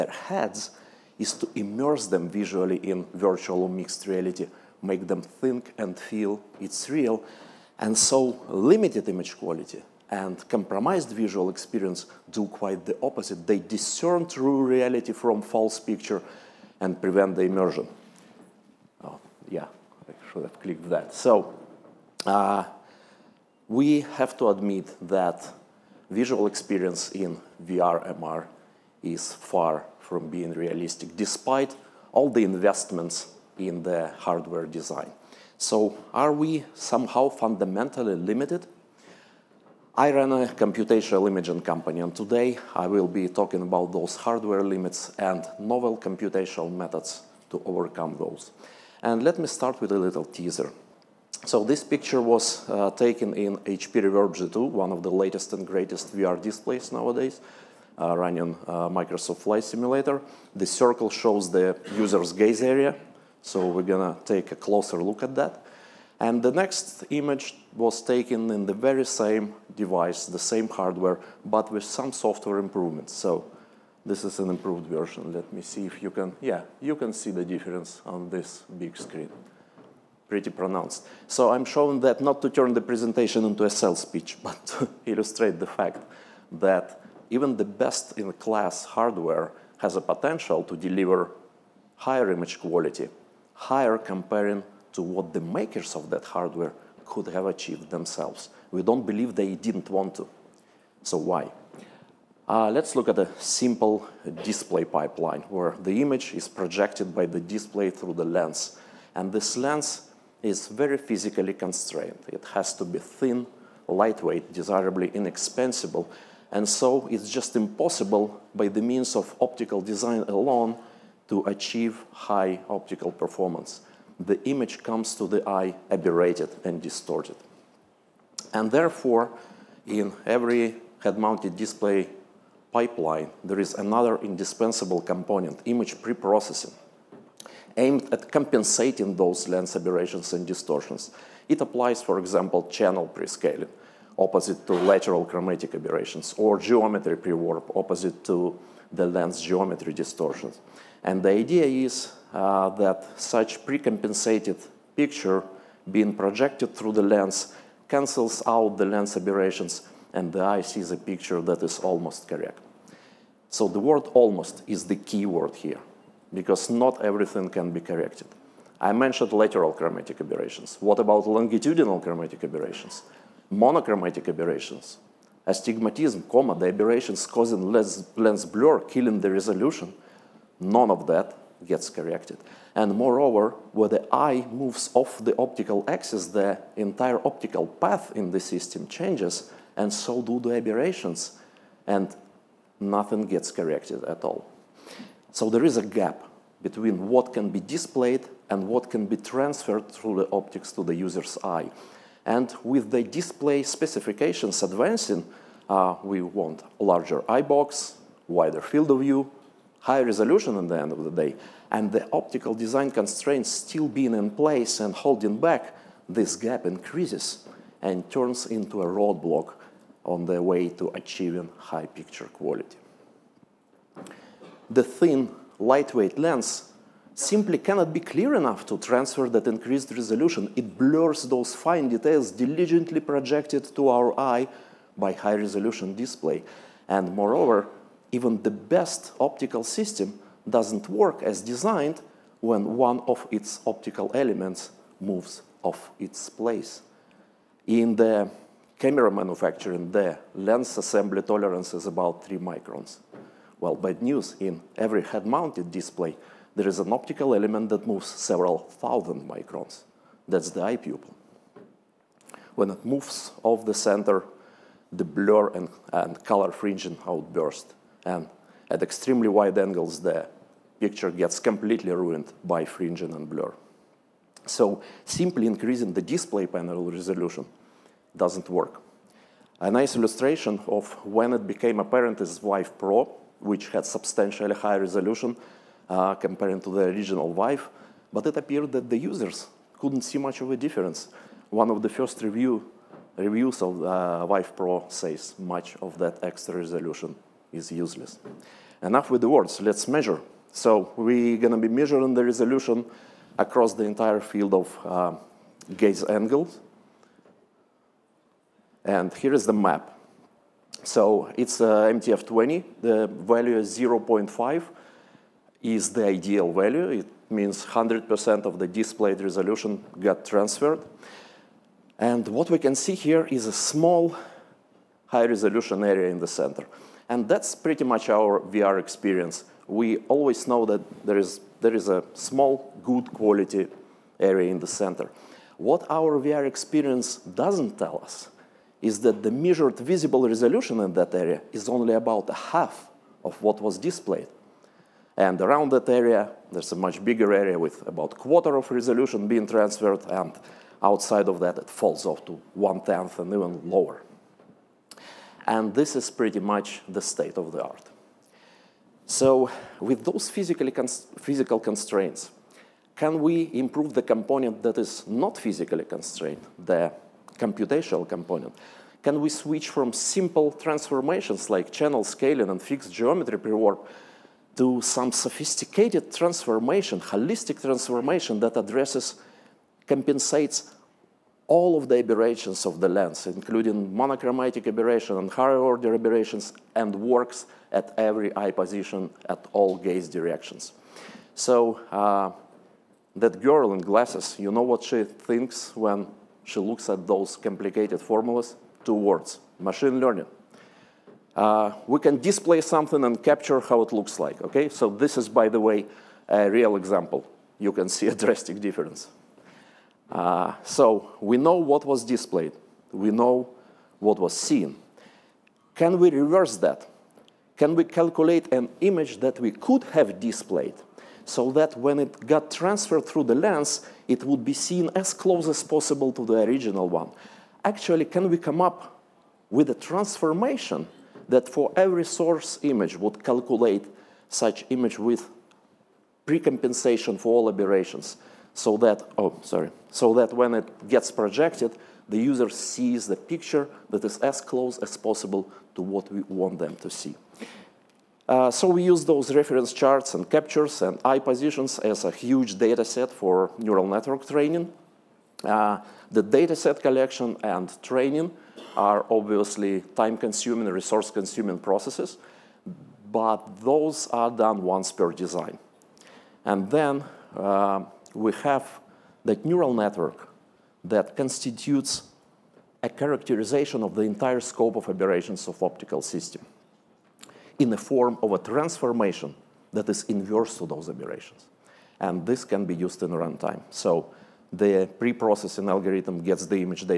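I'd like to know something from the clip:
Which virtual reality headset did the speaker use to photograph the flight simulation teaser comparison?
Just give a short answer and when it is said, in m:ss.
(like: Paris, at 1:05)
HP Reverb G2, at 0:53.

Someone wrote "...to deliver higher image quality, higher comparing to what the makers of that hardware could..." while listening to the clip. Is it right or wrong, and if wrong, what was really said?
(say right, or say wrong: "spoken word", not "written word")
right.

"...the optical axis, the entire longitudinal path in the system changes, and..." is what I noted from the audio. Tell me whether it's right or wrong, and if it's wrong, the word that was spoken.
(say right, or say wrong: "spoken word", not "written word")
wrong: "optical", not "longitudinal".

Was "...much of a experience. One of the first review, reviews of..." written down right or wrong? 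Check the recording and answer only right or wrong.
wrong.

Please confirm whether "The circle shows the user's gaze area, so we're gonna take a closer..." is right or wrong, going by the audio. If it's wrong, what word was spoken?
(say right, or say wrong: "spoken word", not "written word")
right.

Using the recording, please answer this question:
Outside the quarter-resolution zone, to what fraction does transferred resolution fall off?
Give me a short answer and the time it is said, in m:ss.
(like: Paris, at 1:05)
One-tenth, at 5:52.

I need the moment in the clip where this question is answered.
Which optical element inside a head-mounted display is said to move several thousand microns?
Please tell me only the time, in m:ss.
4:20.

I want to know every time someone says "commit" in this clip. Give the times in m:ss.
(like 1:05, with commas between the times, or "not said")
not said.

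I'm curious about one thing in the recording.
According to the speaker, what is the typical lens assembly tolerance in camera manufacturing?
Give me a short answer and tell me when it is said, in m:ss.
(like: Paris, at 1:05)
3 microns, at 4:12.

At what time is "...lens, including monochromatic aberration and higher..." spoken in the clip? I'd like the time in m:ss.
6:22.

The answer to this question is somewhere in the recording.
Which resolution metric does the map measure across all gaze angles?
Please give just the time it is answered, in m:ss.
5:11.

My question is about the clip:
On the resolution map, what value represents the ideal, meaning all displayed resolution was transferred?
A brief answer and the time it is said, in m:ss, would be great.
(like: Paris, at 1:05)
0.5, at 5:13.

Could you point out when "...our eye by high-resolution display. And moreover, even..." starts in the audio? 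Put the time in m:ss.
3:53.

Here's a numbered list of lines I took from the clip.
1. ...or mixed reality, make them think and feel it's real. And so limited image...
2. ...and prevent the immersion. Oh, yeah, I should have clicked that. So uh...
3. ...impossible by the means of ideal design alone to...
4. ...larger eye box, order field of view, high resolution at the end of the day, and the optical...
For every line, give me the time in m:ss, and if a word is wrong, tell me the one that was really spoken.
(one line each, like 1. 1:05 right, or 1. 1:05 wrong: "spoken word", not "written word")
1. 0:03 right
2. 0:16 right
3. 1:57 wrong: "optical", not "ideal"
4. 3:26 wrong: "wider", not "order".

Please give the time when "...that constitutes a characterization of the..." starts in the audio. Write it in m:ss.
7:50.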